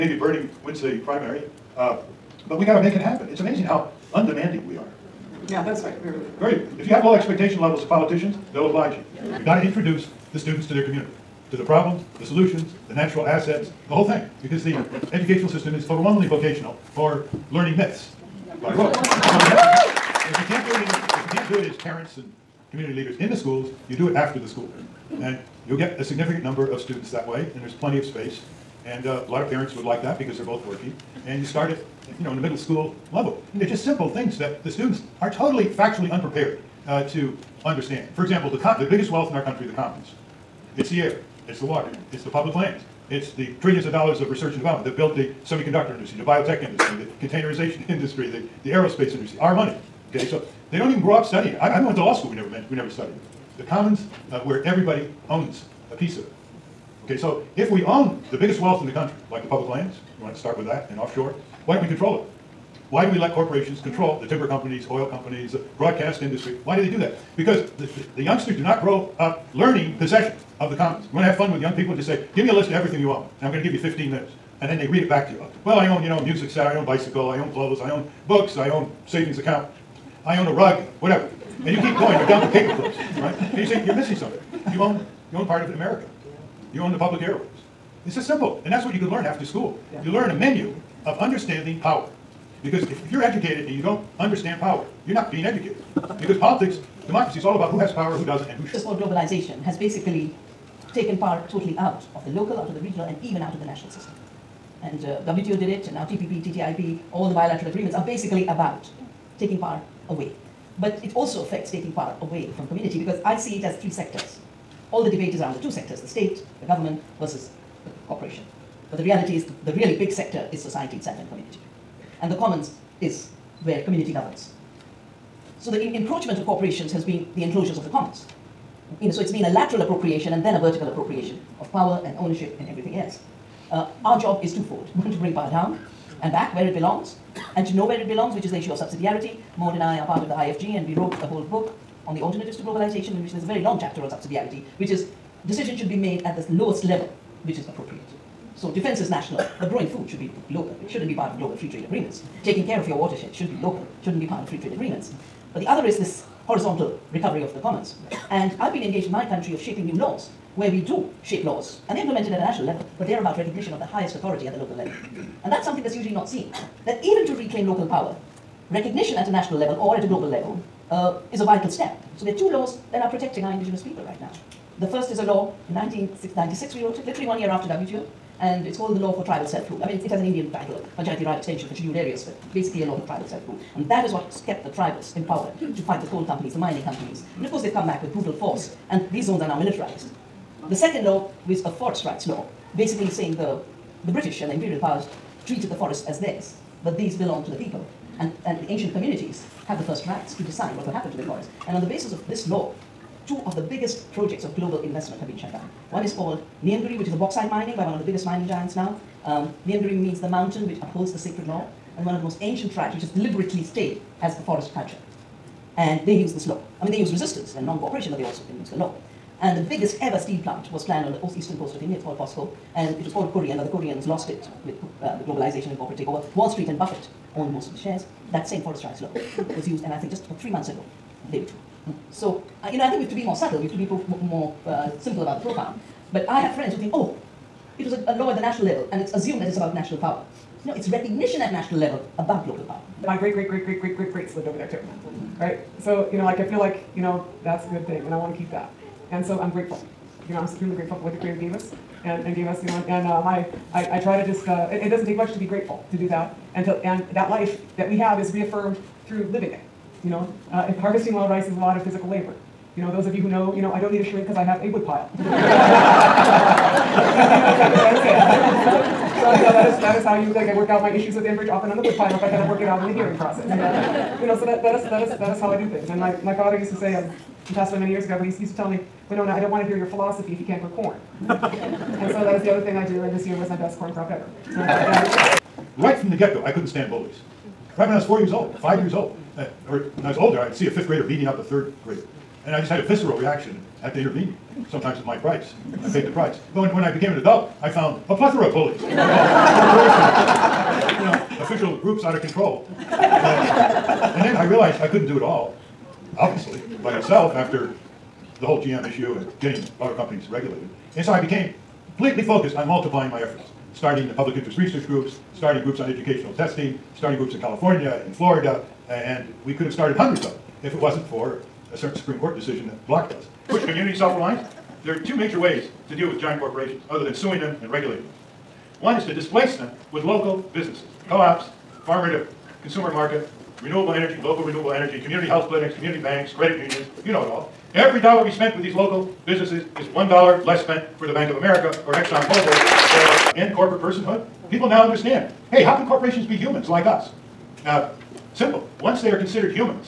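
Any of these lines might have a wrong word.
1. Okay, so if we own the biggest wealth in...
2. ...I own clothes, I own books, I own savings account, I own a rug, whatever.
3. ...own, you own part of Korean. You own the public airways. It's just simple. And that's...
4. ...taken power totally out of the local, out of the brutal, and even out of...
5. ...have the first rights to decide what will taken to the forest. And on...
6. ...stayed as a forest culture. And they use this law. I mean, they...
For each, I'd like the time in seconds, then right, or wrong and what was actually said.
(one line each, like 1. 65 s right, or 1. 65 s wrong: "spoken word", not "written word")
1. 57 s right
2. 77 s right
3. 84 s wrong: "America", not "Korean"
4. 100 s wrong: "regional", not "brutal"
5. 199 s wrong: "happen", not "taken"
6. 213 s right.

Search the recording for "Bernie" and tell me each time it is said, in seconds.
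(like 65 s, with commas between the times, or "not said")
0 s.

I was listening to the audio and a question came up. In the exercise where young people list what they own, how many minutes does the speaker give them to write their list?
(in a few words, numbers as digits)
15.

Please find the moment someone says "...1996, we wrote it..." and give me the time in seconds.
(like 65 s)
175 s.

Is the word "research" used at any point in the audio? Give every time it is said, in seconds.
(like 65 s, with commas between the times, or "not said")
44 s, 314 s.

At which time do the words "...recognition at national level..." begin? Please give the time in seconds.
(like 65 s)
240 s.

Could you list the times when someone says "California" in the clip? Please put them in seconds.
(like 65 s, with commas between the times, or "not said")
317 s.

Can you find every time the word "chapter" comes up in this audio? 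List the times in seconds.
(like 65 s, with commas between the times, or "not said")
143 s.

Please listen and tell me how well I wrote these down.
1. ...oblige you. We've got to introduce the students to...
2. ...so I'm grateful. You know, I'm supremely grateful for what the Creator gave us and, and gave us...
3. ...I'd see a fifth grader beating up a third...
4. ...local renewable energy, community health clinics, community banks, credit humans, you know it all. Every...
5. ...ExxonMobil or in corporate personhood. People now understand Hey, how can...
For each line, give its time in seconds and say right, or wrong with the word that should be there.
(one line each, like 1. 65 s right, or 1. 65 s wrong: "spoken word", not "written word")
1. 8 s right
2. 249 s right
3. 290 s right
4. 334 s wrong: "unions", not "humans"
5. 341 s right.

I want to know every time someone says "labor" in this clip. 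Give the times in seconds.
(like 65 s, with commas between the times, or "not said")
262 s.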